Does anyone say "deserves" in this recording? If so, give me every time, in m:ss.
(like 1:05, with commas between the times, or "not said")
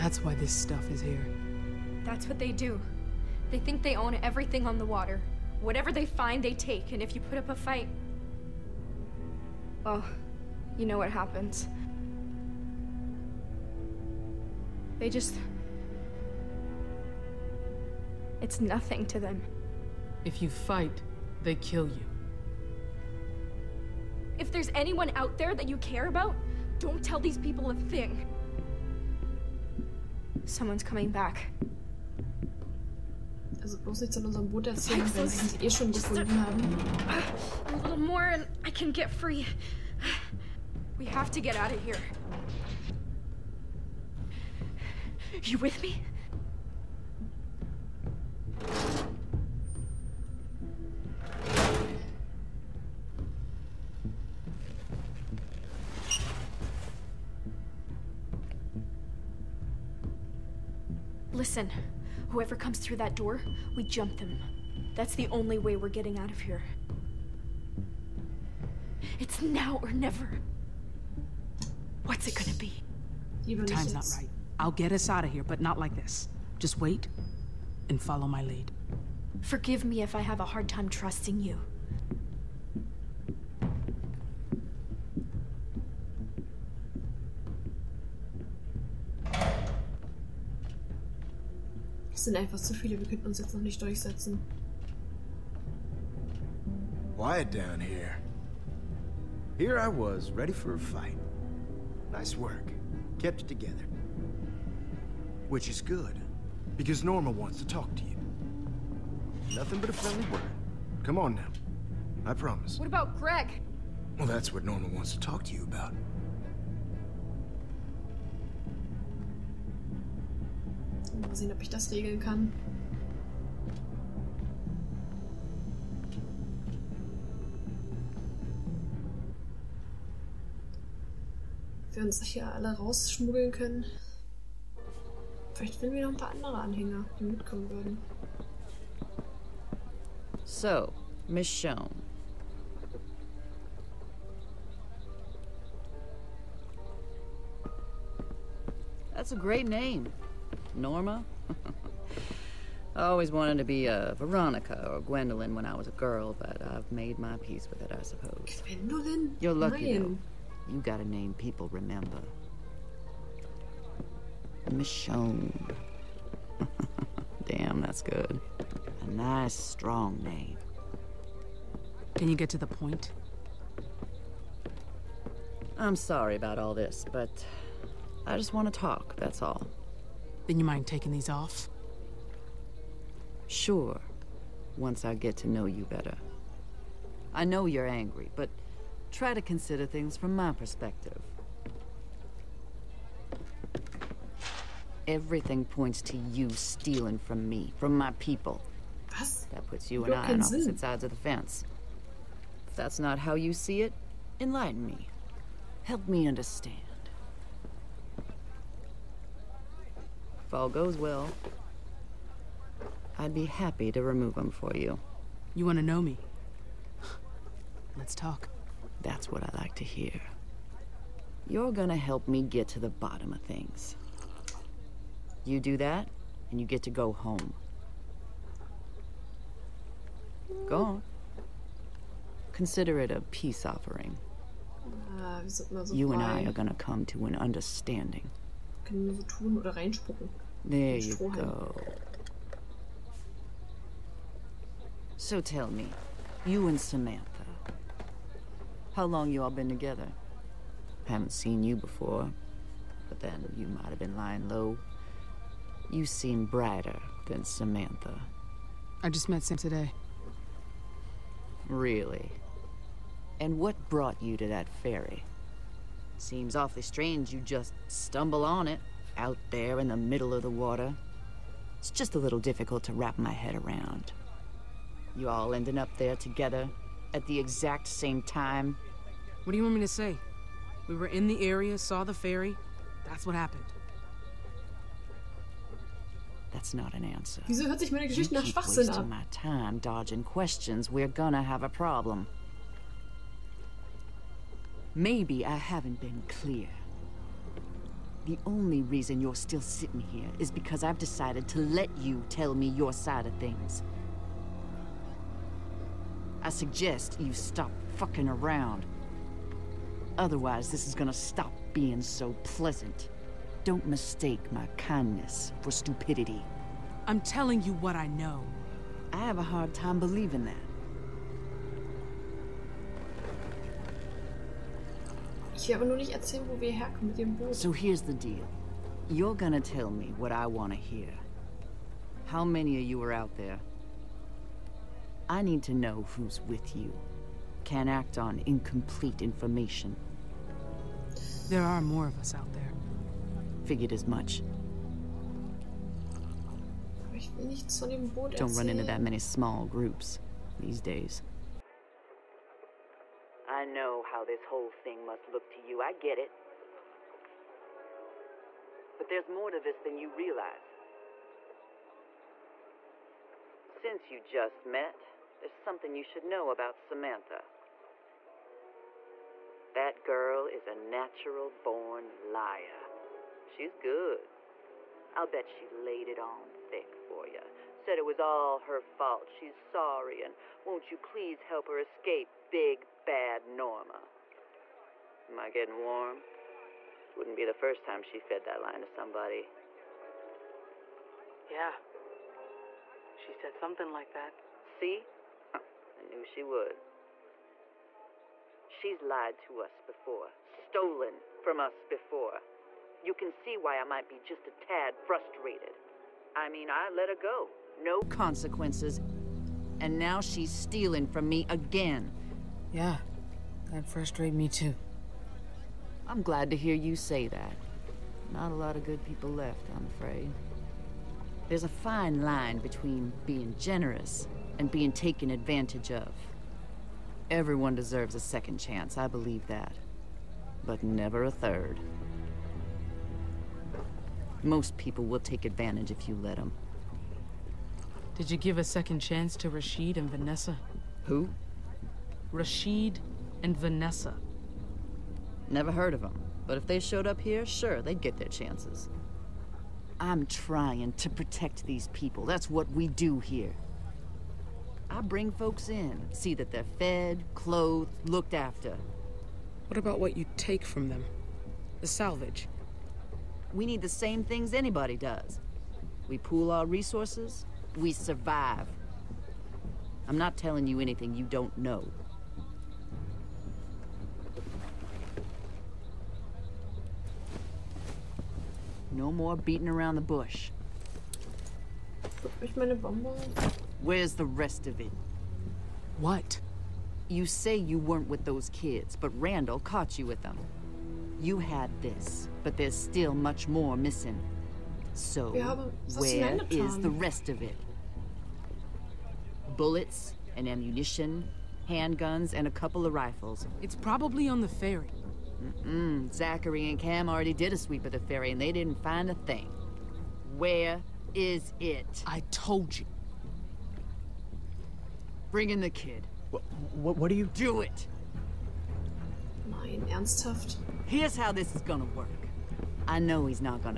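7:07.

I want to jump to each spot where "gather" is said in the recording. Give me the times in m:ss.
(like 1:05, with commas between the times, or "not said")
not said.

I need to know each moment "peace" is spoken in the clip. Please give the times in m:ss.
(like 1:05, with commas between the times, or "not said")
2:37, 3:53.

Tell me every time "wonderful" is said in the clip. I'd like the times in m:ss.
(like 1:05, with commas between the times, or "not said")
not said.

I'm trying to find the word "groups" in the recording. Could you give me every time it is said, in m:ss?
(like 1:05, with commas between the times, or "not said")
5:49.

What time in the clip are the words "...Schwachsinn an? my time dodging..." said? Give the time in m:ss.
4:48.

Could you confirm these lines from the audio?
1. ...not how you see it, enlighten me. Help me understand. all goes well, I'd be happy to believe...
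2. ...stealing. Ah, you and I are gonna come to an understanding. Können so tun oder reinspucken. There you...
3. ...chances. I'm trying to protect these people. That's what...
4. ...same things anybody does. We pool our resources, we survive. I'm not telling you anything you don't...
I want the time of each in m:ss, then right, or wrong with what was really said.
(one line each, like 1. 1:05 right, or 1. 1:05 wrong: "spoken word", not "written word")
1. 3:22 wrong: "remove", not "believe"
2. 3:53 wrong: "offering", not "stealing"
3. 7:28 right
4. 7:43 right.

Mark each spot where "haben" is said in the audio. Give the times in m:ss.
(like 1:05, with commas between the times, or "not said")
0:36.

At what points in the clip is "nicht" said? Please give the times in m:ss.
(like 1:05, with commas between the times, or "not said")
0:34, 1:33, 5:25.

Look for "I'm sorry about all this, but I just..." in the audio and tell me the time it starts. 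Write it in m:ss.
2:55.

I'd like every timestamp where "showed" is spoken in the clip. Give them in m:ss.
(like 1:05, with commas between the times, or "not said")
7:26.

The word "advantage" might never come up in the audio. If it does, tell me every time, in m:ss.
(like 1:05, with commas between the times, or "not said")
7:05, 7:15.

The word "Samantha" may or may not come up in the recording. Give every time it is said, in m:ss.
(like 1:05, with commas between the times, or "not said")
4:06, 4:17, 6:06.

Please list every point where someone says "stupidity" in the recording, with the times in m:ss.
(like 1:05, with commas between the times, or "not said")
5:15.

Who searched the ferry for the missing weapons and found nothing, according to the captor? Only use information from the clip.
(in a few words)
Zachary and Cam.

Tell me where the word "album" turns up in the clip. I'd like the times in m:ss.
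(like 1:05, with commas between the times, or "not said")
not said.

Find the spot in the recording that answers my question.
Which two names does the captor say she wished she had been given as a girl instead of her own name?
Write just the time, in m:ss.
2:34.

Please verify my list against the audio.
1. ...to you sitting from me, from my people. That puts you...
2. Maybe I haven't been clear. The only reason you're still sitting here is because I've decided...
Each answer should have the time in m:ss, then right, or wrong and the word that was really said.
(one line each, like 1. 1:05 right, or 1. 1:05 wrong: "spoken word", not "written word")
1. 3:16 wrong: "stealing", not "sitting"
2. 4:54 right.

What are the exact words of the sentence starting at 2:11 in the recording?
wir uns hier alle rausschmuggeln können.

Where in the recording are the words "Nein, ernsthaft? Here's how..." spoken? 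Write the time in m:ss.
8:39.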